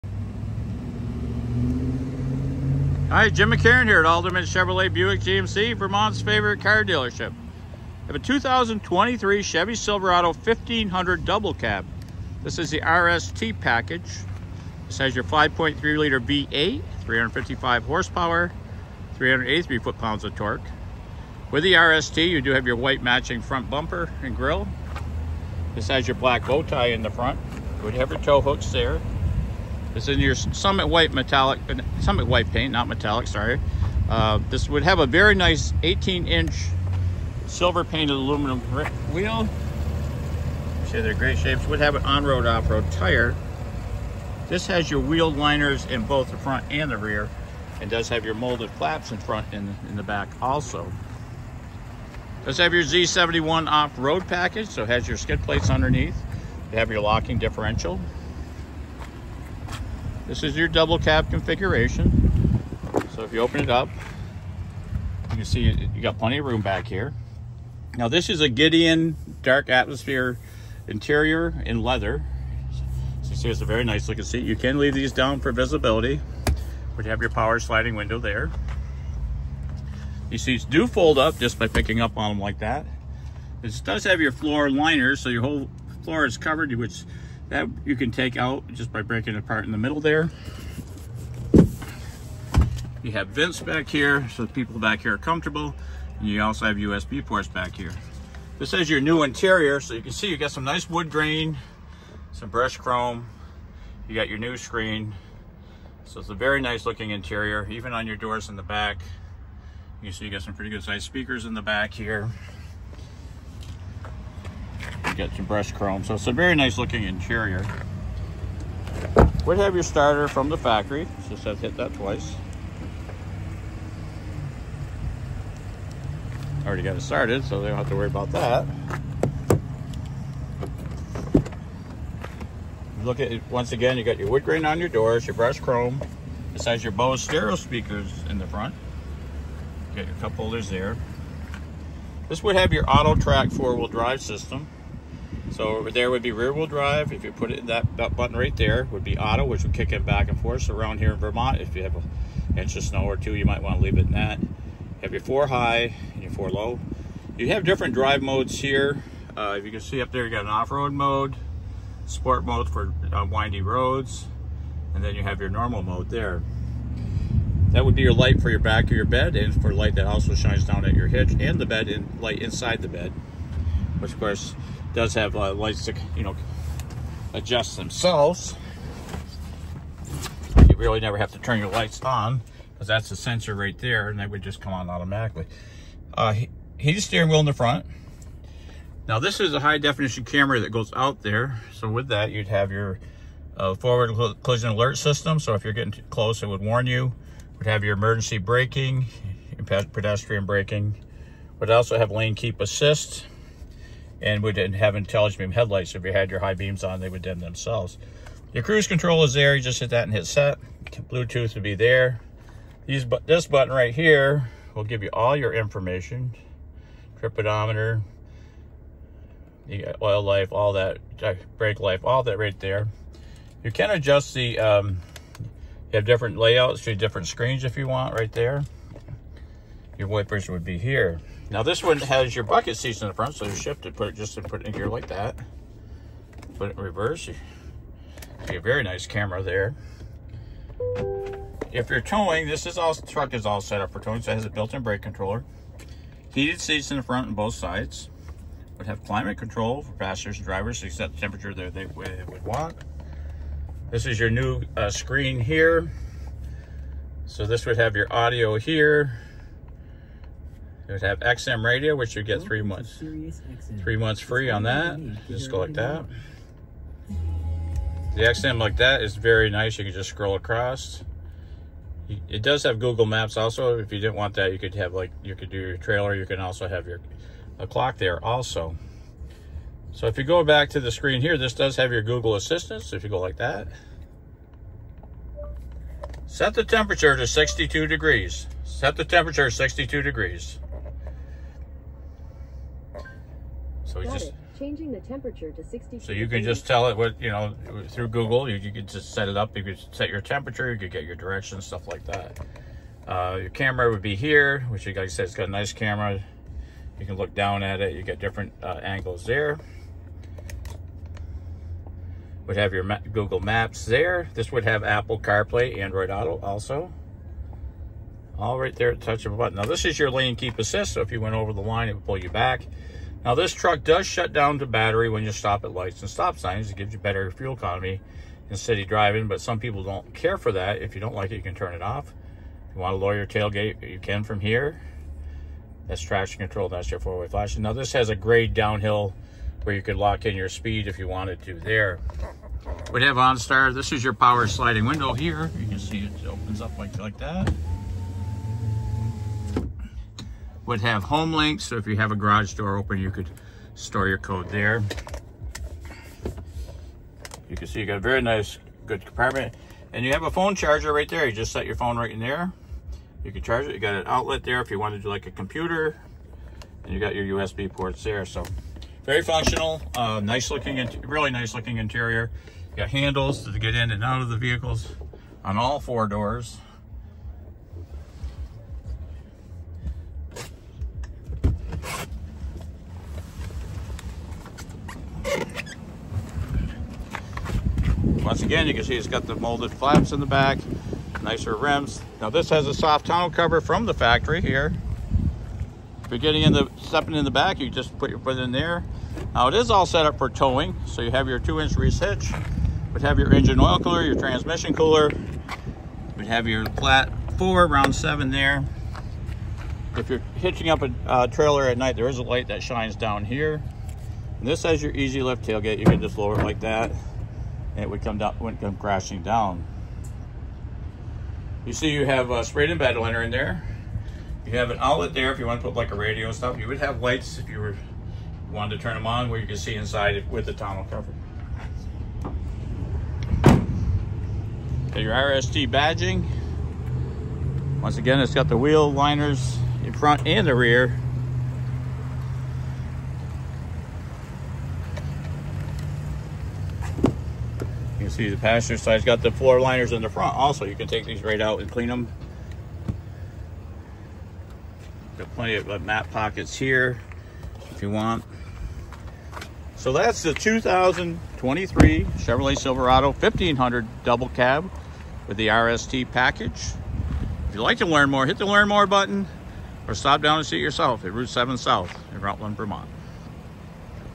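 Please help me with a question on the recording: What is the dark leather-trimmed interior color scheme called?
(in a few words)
Gideon.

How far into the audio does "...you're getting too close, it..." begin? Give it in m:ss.
3:15.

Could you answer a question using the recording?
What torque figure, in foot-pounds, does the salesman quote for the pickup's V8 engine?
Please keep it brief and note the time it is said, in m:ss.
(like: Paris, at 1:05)
383, at 0:19.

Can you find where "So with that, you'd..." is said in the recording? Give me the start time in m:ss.
3:11.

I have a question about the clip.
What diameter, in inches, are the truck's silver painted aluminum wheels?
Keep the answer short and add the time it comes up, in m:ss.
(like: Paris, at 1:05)
18 inch, at 0:35.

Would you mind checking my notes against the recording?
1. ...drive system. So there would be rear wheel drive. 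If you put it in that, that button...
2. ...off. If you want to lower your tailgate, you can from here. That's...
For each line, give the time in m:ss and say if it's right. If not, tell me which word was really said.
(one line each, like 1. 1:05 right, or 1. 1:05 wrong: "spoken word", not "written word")
1. 2:23 right
2. 5:31 right.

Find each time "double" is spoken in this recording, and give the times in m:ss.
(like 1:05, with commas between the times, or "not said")
0:11, 1:00, 7:44.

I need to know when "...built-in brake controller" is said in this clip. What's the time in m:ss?
4:04.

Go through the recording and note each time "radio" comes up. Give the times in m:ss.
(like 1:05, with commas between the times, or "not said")
4:21, 7:05.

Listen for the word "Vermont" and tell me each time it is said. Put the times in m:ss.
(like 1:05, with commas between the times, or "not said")
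0:05, 2:31, 7:52.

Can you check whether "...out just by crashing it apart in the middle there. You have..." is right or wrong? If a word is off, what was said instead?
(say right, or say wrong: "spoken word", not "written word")
wrong: "breaking", not "crashing".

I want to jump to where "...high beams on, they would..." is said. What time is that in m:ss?
3:26.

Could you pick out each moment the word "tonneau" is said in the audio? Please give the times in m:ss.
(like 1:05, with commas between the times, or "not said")
6:33, 7:10.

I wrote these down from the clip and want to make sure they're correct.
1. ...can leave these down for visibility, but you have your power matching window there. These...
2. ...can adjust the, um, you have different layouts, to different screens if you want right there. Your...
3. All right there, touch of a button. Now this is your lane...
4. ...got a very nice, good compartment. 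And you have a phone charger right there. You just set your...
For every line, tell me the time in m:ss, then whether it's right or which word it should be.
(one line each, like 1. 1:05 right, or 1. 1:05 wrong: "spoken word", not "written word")
1. 1:14 wrong: "sliding", not "matching"
2. 3:43 right
3. 5:18 right
4. 5:57 right.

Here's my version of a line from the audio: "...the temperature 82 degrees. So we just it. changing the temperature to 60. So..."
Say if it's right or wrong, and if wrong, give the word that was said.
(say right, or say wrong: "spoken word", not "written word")
wrong: "62", not "82".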